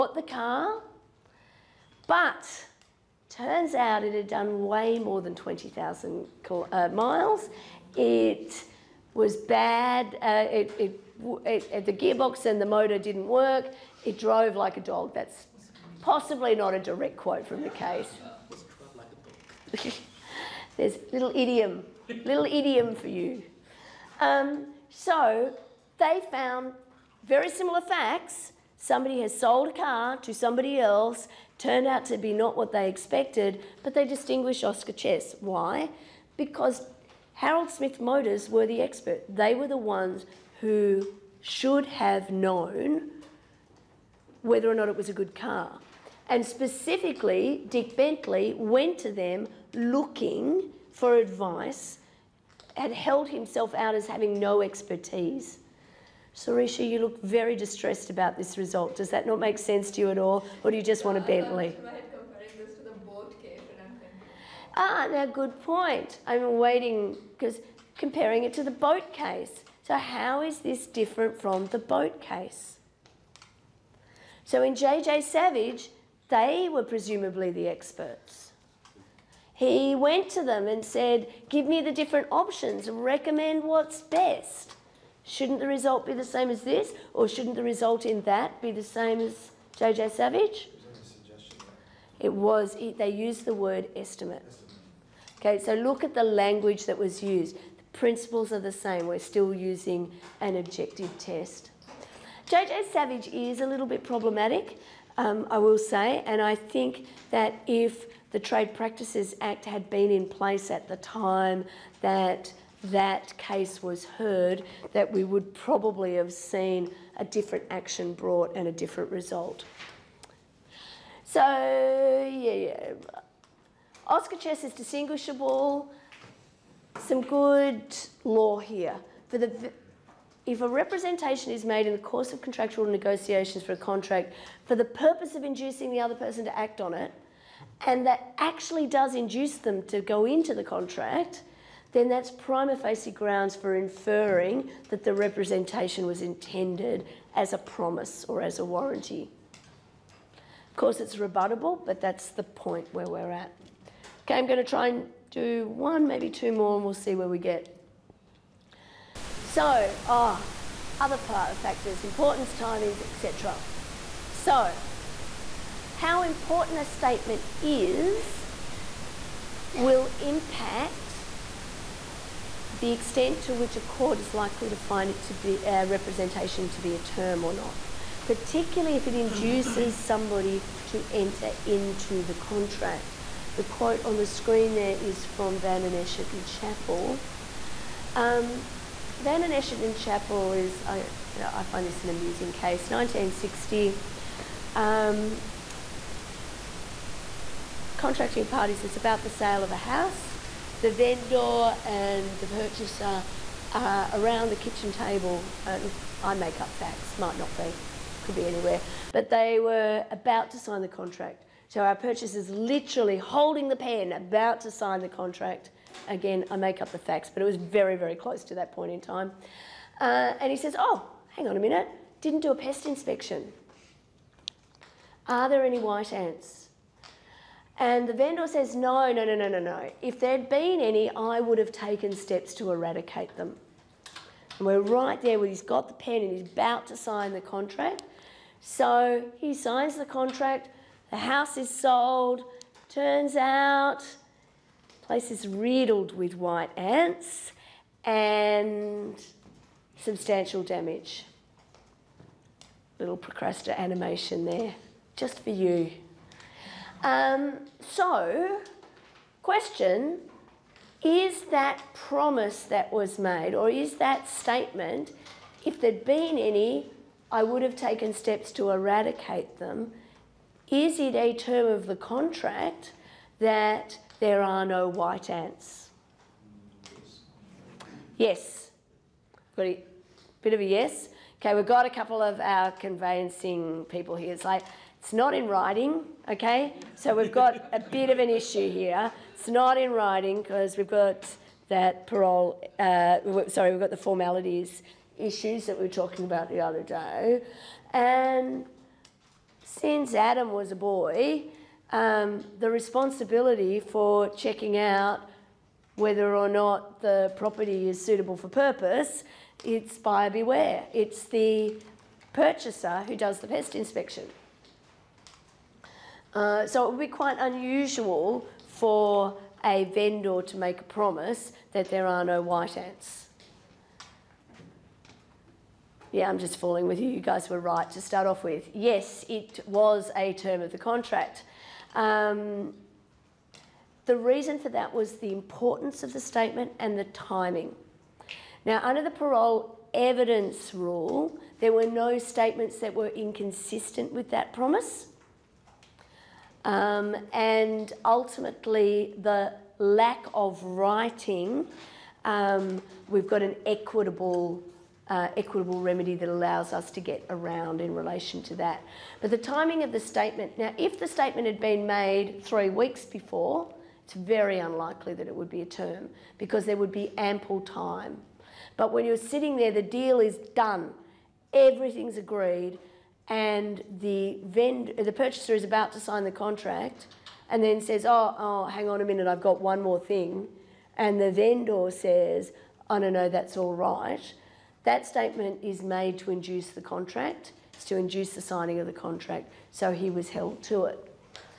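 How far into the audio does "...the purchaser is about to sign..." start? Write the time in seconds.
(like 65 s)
374 s.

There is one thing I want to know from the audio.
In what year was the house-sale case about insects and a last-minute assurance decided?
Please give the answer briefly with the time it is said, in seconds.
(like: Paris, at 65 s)
1960, at 192 s.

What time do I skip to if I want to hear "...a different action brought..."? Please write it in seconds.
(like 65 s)
117 s.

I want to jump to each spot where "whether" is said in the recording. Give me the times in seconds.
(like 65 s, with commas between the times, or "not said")
44 s, 305 s.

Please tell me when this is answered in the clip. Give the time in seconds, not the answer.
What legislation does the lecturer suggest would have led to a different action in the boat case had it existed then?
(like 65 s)
108 s.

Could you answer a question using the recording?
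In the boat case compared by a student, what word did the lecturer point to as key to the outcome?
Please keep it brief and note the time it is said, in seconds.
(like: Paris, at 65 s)
estimate, at 93 s.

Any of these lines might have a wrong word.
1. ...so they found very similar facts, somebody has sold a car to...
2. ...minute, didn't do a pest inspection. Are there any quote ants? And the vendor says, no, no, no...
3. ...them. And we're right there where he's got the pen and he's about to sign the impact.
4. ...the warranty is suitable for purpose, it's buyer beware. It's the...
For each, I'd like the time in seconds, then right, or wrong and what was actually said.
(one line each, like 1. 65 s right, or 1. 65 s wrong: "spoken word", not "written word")
1. 24 s right
2. 221 s wrong: "white", not "quote"
3. 233 s wrong: "contract", not "impact"
4. 306 s wrong: "property", not "warranty".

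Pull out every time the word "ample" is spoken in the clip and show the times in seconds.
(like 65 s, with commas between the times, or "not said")
367 s.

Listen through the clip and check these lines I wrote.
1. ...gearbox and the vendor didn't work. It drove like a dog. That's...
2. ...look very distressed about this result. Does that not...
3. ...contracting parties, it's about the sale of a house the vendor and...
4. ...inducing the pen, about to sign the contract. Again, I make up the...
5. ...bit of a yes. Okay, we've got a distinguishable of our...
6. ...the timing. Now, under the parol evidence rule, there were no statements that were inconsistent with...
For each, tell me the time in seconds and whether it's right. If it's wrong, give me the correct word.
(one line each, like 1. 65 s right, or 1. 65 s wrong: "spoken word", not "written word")
1. 11 s wrong: "motor", not "vendor"
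2. 56 s right
3. 197 s right
4. 213 s wrong: "holding", not "inducing"
5. 280 s wrong: "couple", not "distinguishable"
6. 336 s right.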